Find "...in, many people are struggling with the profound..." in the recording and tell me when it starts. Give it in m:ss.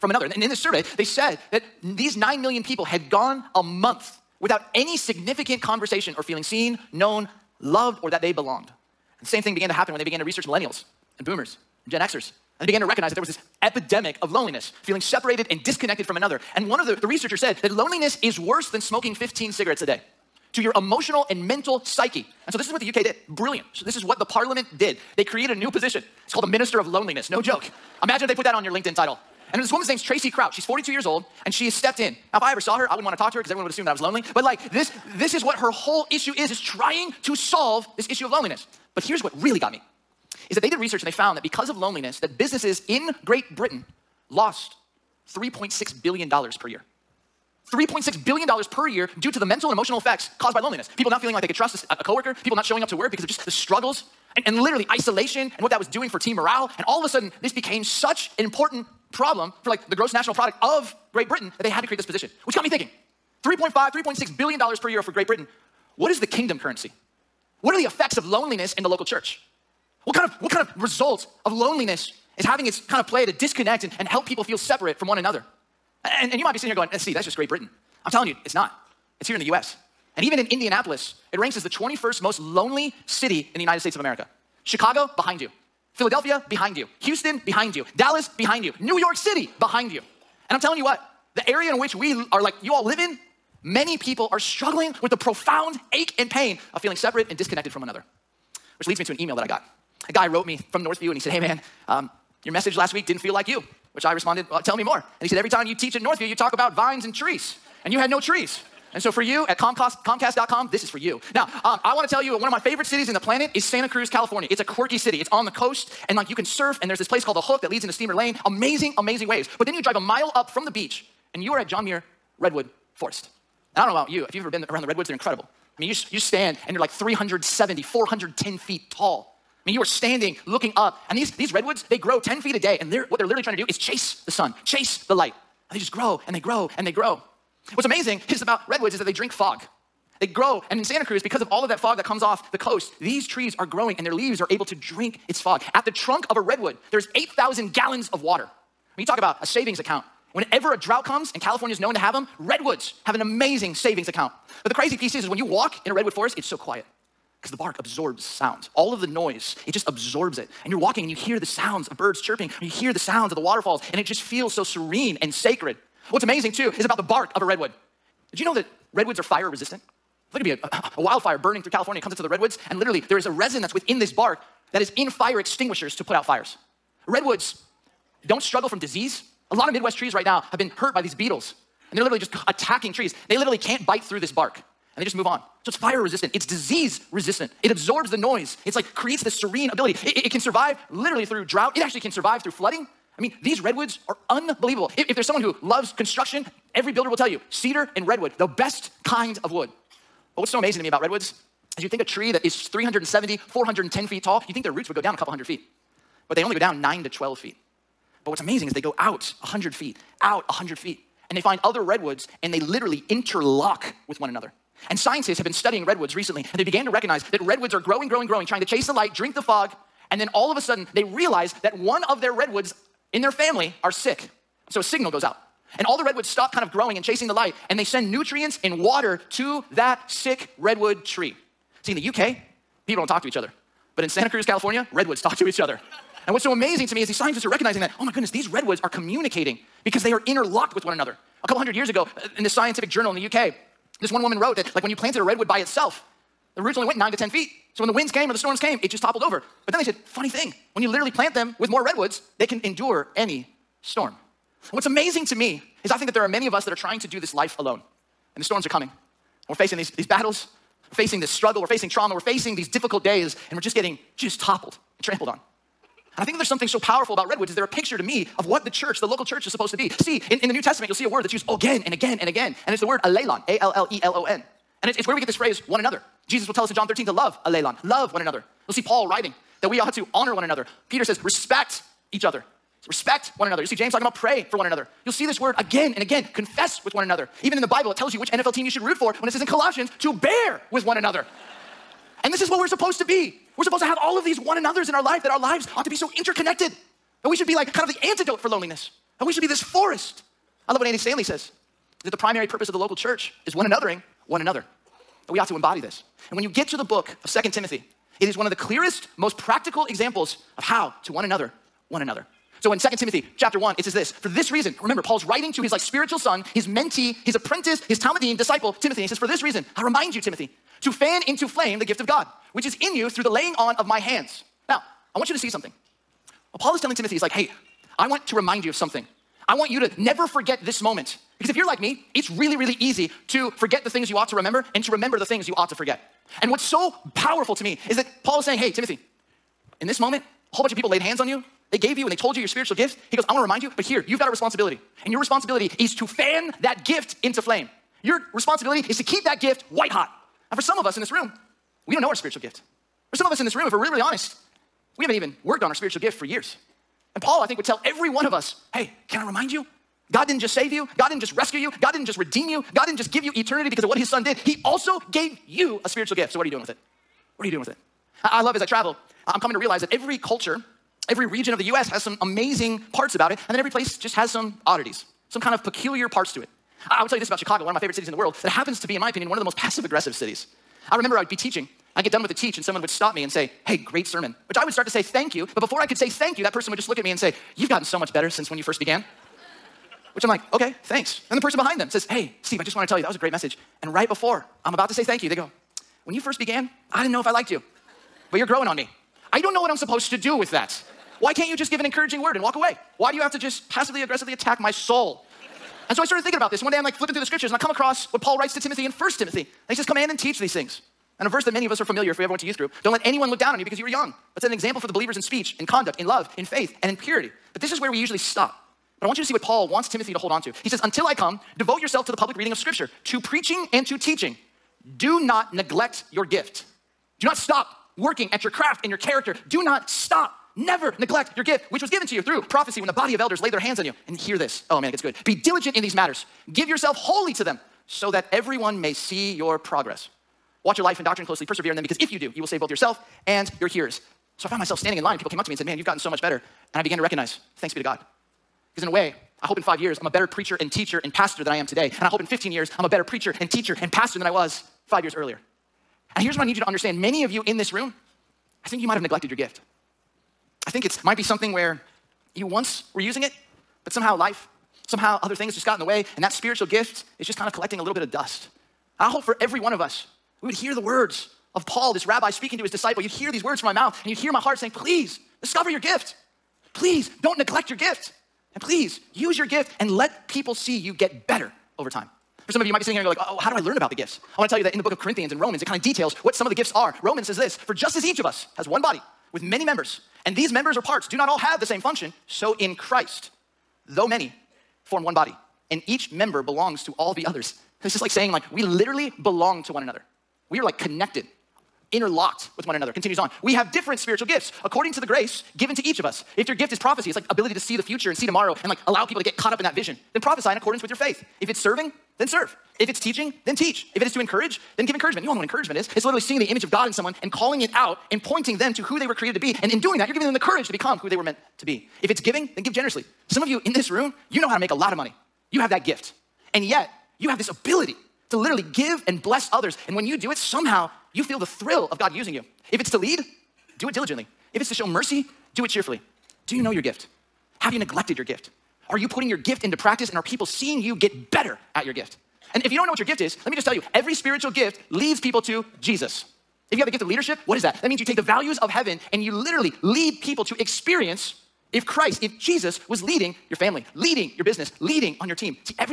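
1:32.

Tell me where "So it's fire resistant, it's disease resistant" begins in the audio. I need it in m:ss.
3:05.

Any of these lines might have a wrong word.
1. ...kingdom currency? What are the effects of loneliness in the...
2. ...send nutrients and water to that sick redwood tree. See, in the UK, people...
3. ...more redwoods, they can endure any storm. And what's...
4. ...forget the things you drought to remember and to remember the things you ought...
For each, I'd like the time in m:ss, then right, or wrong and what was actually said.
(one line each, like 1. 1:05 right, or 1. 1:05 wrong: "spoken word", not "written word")
1. 1:06 right
2. 3:47 right
3. 4:11 right
4. 5:33 wrong: "ought", not "drought".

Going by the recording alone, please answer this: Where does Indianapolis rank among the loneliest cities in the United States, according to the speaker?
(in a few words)
21st.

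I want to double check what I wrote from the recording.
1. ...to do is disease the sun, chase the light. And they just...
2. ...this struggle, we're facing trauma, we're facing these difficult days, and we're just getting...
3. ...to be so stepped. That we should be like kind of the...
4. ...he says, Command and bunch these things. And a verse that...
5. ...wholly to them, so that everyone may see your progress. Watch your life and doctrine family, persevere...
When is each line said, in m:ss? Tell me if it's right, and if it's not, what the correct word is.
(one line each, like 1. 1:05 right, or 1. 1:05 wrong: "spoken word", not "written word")
1. 2:13 wrong: "chase", not "disease"
2. 4:21 right
3. 4:55 wrong: "interconnected", not "stepped"
4. 6:49 wrong: "teach", not "bunch"
5. 7:16 wrong: "closely", not "family".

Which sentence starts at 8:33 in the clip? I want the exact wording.
If it is to encourage, then give encouragement.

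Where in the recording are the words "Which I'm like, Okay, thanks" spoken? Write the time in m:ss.
6:30.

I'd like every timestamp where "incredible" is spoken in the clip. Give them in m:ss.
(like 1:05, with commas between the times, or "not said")
2:05.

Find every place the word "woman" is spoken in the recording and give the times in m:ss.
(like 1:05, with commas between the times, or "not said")
0:29, 4:04.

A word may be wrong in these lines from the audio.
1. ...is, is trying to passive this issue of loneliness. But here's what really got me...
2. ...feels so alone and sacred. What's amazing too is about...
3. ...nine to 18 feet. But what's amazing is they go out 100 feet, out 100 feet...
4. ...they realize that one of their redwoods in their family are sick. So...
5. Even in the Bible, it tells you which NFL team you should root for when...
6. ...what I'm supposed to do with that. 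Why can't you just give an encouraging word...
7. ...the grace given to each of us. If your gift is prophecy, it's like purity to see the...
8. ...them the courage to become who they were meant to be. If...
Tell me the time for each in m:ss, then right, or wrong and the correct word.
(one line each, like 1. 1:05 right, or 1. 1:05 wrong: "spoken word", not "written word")
1. 0:36 wrong: "solve", not "passive"
2. 2:44 wrong: "serene", not "alone"
3. 3:26 wrong: "12", not "18"
4. 3:40 right
5. 4:47 right
6. 6:39 right
7. 8:24 wrong: "ability", not "purity"
8. 8:40 right.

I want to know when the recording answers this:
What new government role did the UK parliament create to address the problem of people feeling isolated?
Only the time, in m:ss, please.
0:26.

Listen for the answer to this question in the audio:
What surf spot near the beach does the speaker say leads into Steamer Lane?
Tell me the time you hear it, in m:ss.
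1:57.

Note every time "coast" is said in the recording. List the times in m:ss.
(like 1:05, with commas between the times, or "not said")
1:55, 2:22.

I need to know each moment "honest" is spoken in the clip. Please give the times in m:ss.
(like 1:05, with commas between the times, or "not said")
5:54.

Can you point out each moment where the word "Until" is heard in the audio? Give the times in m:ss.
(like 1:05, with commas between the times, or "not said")
7:00.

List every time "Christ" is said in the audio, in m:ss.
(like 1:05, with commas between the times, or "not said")
8:12, 9:11.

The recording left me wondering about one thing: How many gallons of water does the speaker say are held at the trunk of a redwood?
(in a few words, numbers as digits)
8,000.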